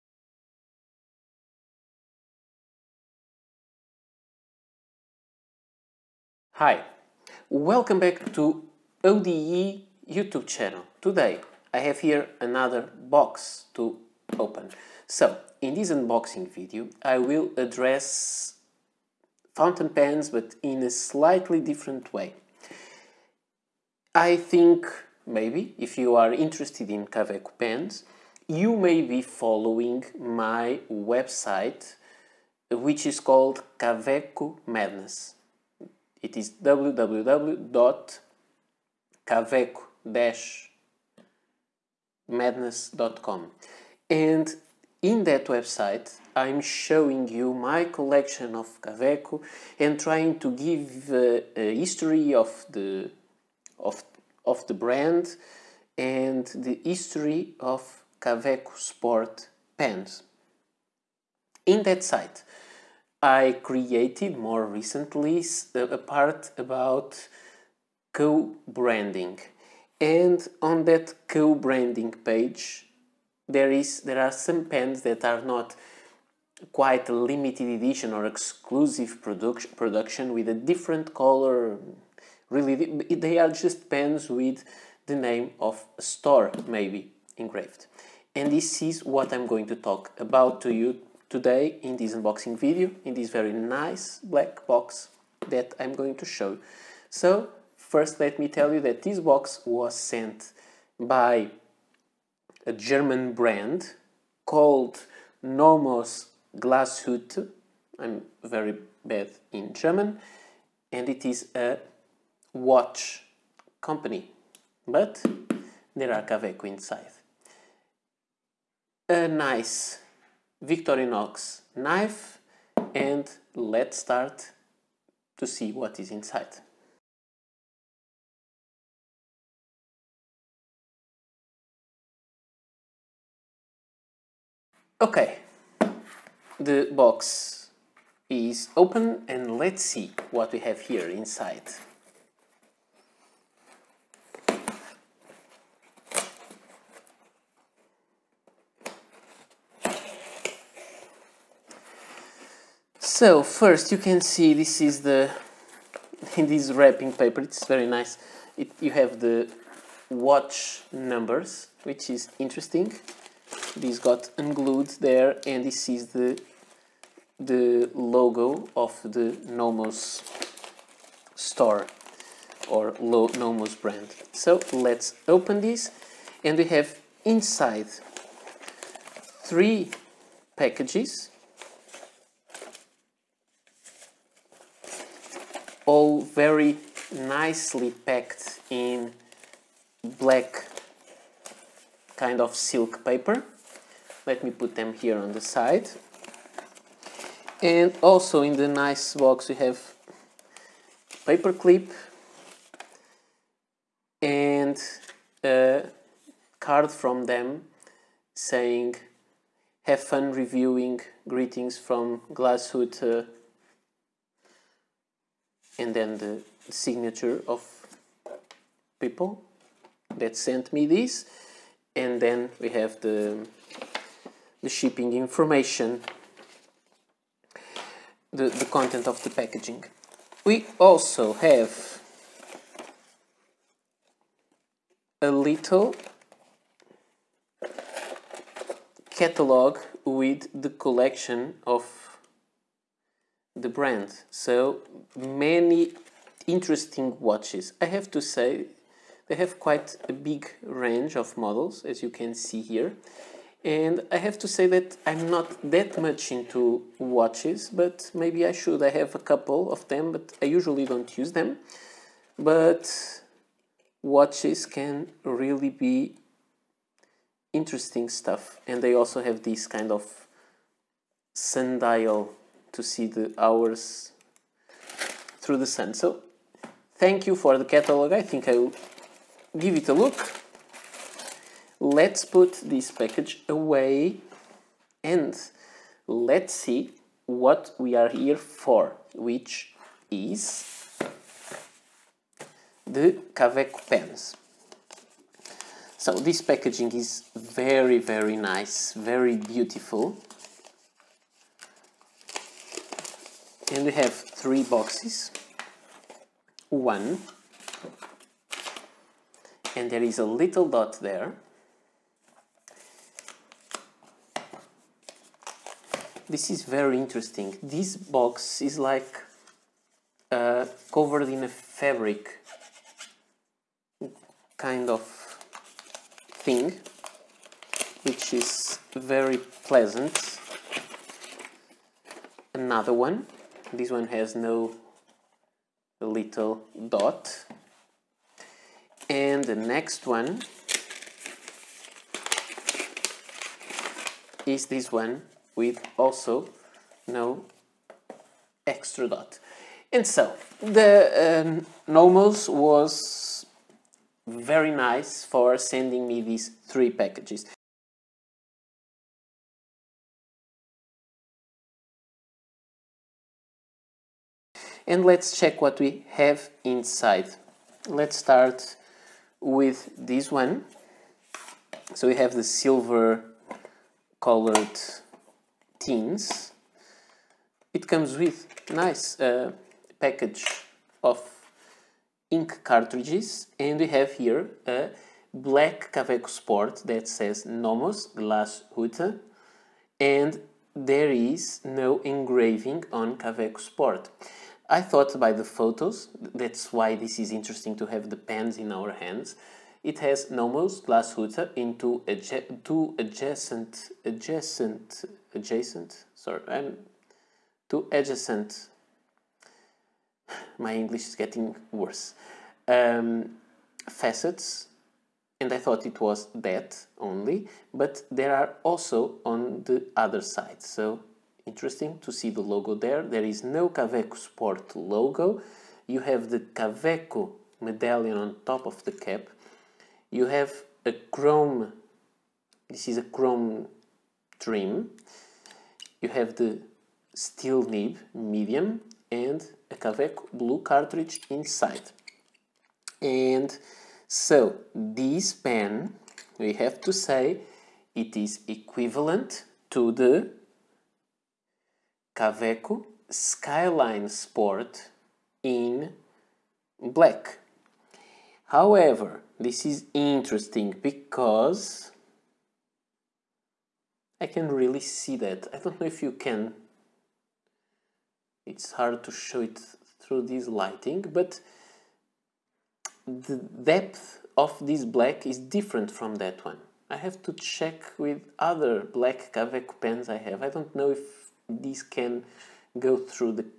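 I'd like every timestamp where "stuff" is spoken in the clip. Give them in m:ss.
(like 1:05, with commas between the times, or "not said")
4:28.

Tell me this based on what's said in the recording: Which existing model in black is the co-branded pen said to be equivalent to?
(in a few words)
Kaweco Skyline Sport.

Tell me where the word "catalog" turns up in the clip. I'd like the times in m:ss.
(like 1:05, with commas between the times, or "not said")
3:59, 4:37.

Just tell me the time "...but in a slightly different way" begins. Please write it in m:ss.
0:20.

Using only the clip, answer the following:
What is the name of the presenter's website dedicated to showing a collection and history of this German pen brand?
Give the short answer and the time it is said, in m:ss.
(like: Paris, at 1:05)
Kaweco Madness, at 0:33.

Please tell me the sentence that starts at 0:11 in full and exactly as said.
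Today I have here another box to open.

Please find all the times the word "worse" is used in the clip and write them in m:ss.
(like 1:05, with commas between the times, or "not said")
6:51.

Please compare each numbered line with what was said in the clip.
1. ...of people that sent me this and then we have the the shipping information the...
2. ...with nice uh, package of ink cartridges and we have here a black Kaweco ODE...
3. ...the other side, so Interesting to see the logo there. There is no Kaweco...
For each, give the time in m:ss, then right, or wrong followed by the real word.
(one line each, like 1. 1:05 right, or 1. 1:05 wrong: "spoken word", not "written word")
1. 3:37 right
2. 6:18 wrong: "Sport", not "ODE"
3. 6:59 right.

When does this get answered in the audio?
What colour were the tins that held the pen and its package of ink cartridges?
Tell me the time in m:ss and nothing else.
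6:12.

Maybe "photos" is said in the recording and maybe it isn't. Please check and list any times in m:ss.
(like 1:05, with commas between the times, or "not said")
6:35.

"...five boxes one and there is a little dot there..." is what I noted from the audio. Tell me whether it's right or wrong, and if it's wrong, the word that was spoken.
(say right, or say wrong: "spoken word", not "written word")
wrong: "three", not "five".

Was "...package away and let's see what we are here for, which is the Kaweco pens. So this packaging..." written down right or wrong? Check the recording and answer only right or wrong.
right.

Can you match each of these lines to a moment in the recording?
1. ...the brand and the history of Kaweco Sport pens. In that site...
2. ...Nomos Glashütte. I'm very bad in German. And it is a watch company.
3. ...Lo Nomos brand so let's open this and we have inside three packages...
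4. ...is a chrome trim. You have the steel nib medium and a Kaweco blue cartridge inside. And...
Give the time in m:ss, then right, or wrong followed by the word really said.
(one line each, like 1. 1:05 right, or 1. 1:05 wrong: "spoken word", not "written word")
1. 0:54 right
2. 1:45 right
3. 2:52 right
4. 7:12 right.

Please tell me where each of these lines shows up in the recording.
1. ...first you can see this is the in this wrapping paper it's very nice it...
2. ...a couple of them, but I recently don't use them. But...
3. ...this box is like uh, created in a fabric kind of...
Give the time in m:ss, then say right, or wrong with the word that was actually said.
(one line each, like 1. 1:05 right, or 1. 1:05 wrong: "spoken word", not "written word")
1. 2:33 right
2. 4:19 wrong: "usually", not "recently"
3. 5:17 wrong: "covered", not "created".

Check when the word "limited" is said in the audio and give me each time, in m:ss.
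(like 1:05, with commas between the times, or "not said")
1:17.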